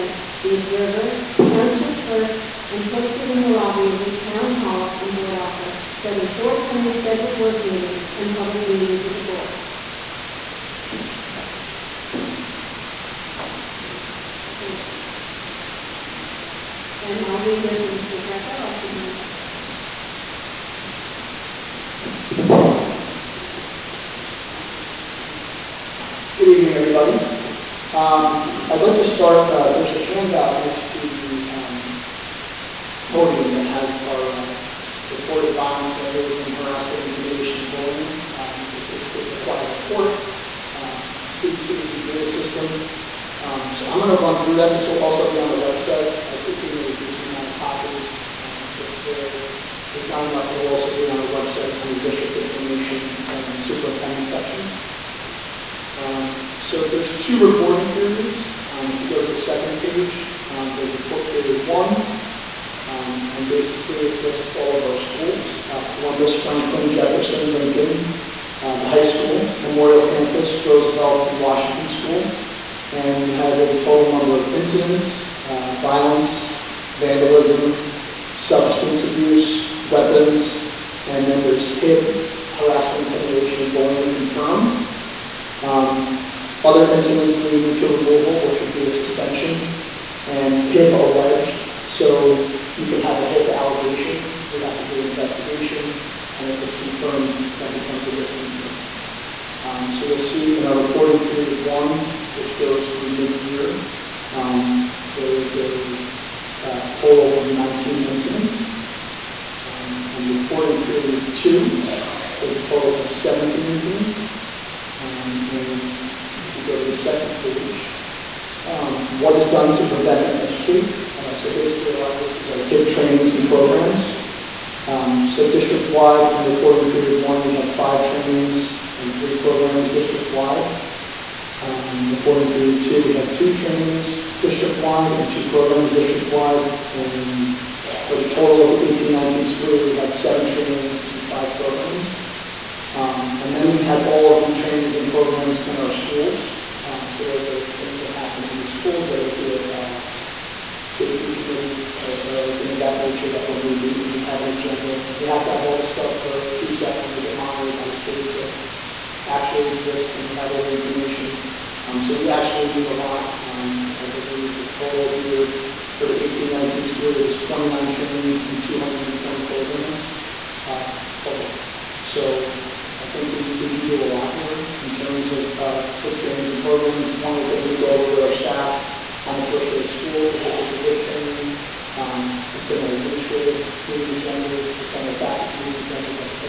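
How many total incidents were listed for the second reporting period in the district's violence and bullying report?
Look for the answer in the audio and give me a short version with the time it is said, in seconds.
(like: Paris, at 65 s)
17, at 113 s.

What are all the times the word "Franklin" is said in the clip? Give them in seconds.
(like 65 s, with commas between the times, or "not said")
66 s.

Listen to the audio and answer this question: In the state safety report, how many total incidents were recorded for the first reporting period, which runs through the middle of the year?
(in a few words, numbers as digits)
19.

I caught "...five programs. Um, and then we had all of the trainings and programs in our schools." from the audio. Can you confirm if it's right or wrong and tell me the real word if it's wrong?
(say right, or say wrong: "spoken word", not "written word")
right.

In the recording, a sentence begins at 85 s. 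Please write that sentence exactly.
Um, other incidents leading to removal, which would be a suspension, and HIB alleged.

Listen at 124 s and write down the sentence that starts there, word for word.
Um, so district-wide, in reporting period one, we had five trainings and three programs district-wide.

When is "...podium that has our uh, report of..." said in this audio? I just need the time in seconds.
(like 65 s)
33 s.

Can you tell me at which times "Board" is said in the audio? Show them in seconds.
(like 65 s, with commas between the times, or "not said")
5 s, 9 s.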